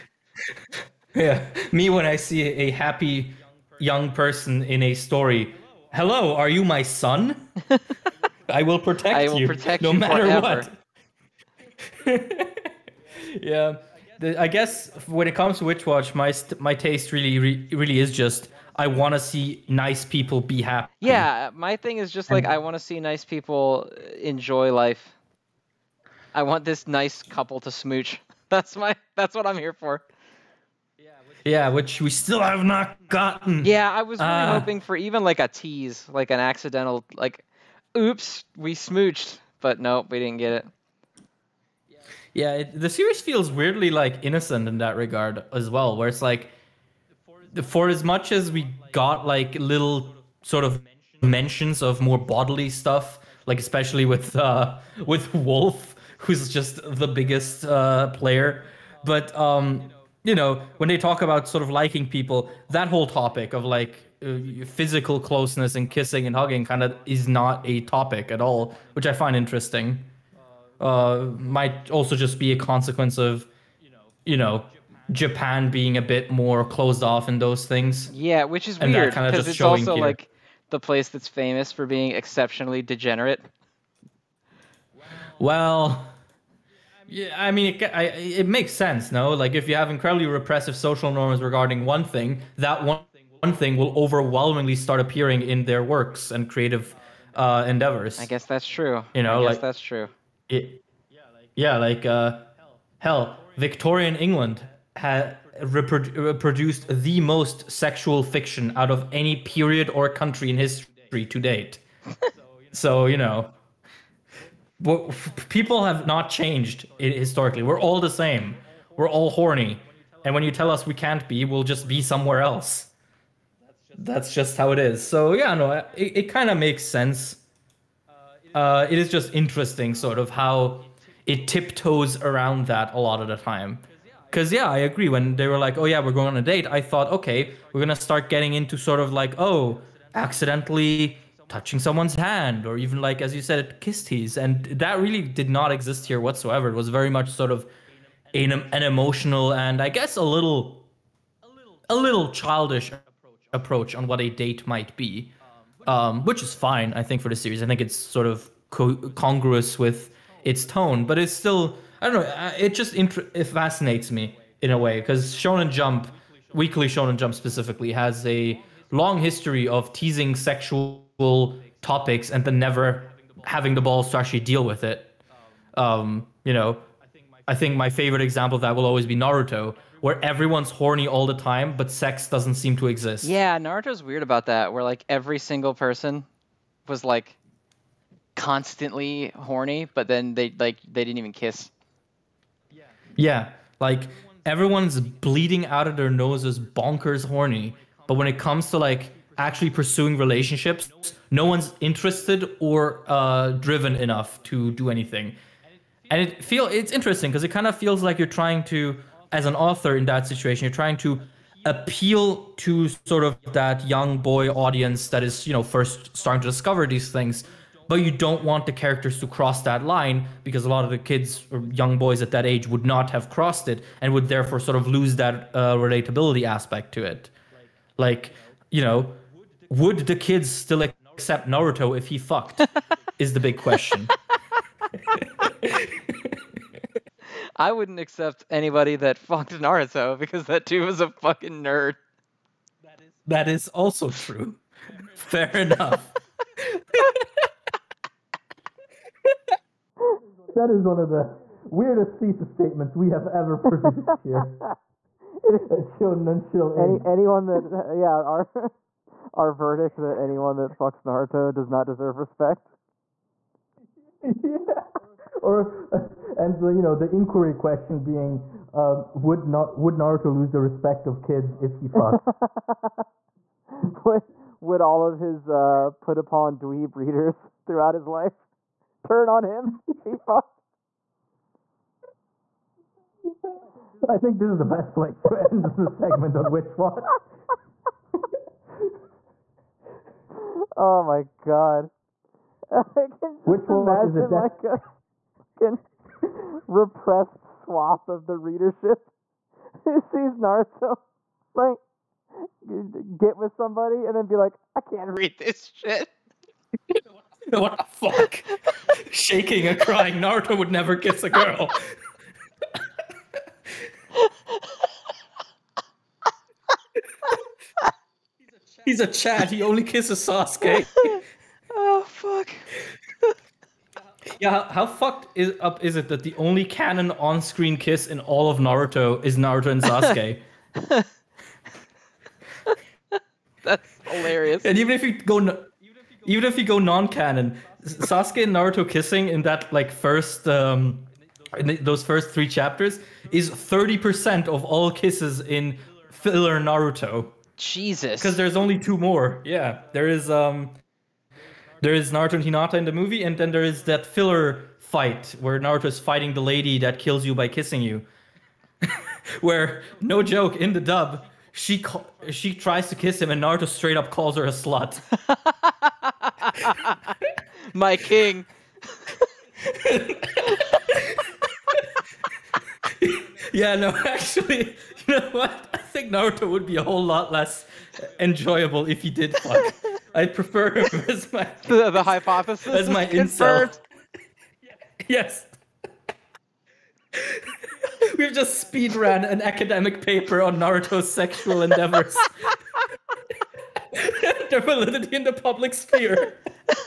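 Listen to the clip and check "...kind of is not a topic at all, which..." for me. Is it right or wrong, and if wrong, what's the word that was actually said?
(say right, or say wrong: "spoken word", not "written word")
right.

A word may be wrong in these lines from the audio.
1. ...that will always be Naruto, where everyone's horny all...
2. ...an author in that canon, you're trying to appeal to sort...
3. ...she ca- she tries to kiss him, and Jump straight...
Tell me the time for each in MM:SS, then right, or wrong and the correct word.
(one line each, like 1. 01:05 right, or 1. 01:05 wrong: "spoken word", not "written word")
1. 02:58 right
2. 03:29 wrong: "situation", not "canon"
3. 06:01 wrong: "Naruto", not "Jump".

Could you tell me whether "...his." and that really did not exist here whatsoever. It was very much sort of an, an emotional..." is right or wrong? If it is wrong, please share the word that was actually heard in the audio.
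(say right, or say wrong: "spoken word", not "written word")
right.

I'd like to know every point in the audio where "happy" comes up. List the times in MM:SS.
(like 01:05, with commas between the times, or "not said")
00:02, 00:20.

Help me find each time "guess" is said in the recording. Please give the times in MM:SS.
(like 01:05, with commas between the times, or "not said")
00:14, 01:38, 02:29.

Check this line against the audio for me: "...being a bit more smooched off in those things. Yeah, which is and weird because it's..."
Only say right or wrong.
wrong.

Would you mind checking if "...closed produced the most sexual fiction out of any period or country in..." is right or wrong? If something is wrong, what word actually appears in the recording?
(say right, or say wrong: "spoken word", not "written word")
wrong: "reproduced", not "closed".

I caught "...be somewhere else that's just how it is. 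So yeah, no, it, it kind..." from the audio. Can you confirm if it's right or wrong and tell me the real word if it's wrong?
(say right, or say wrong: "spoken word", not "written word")
right.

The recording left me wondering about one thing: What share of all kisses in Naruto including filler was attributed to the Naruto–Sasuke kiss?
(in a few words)
30 percent.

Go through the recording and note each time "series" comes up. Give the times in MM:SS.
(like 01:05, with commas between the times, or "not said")
00:42, 02:37.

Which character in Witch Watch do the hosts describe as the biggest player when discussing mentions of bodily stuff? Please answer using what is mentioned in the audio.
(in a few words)
Wolf.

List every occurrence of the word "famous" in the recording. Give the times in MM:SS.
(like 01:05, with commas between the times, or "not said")
01:21.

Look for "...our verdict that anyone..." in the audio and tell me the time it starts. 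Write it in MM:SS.
04:19.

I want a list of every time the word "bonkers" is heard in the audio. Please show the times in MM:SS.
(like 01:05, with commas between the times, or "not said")
03:16.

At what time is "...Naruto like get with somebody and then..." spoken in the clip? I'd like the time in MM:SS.
05:00.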